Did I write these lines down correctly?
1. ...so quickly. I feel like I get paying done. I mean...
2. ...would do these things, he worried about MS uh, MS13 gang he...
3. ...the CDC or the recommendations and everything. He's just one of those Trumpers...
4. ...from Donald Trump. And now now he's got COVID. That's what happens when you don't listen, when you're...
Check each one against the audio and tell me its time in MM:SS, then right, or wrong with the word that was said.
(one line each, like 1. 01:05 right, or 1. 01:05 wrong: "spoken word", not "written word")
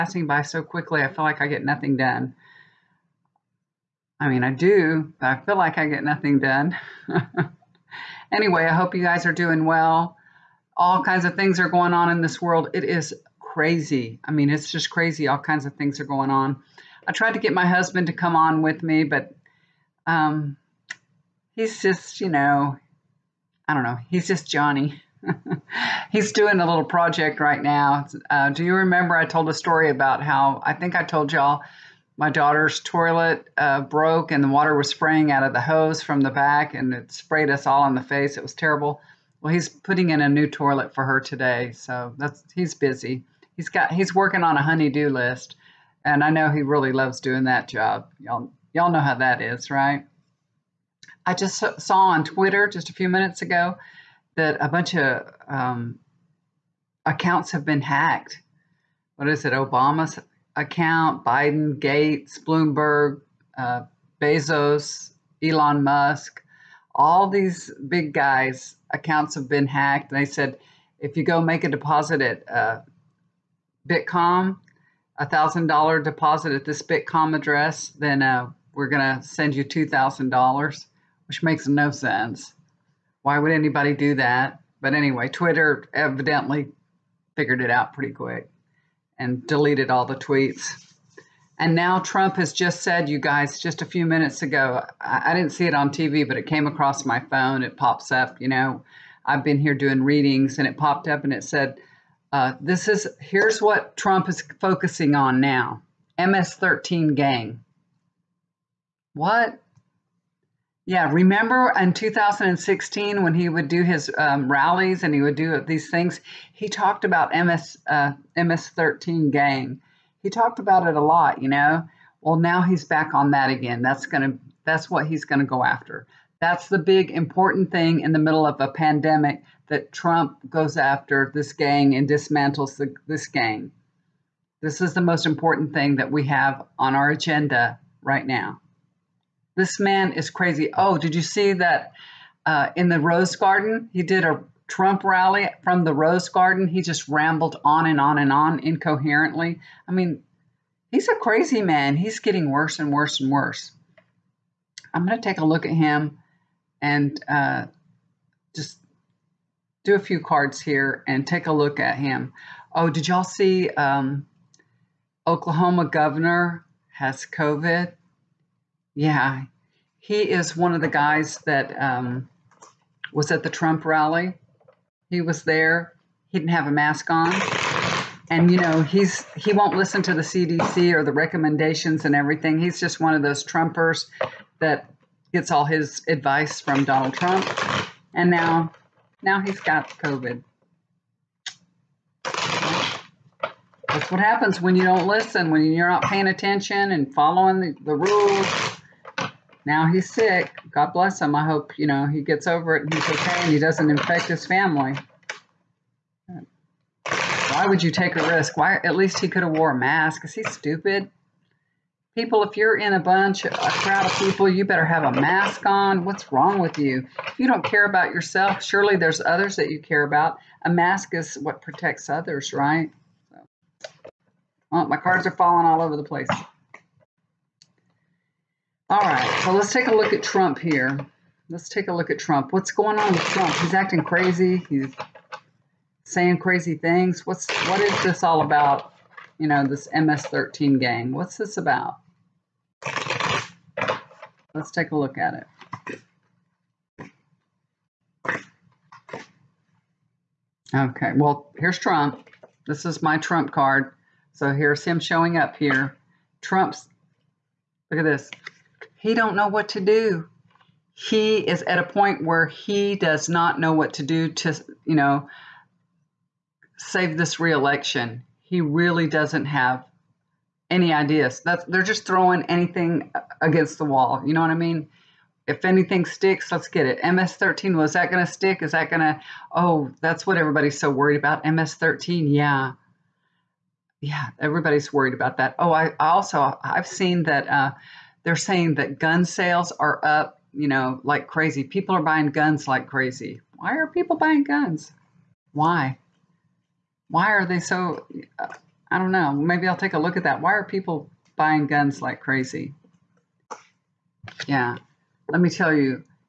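1. 00:00 wrong: "nothing", not "paying"
2. 01:55 wrong: "talked", not "worried"
3. 03:00 right
4. 03:06 right.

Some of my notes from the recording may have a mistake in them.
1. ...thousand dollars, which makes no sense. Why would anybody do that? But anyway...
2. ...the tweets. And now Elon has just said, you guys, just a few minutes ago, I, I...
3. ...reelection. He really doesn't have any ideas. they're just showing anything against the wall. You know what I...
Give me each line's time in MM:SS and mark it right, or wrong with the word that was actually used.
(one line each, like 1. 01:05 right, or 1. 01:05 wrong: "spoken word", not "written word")
1. 01:19 right
2. 01:30 wrong: "Trump", not "Elon"
3. 04:27 wrong: "throwing", not "showing".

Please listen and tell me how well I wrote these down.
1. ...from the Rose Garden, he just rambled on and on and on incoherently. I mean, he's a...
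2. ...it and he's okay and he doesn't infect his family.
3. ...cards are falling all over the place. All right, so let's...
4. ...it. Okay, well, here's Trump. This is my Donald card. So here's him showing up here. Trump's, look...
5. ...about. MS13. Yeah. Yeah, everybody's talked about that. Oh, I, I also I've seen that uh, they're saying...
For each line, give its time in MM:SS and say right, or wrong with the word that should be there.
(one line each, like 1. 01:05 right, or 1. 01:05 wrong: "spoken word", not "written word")
1. 02:25 right
2. 03:22 right
3. 03:44 right
4. 04:05 wrong: "Trump", not "Donald"
5. 04:41 wrong: "worried", not "talked".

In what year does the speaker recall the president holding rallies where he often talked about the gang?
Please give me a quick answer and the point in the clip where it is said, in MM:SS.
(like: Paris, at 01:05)
2016, at 01:51.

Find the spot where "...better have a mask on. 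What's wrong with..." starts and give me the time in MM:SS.
03:34.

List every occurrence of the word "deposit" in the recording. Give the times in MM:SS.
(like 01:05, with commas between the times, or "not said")
01:11, 01:16.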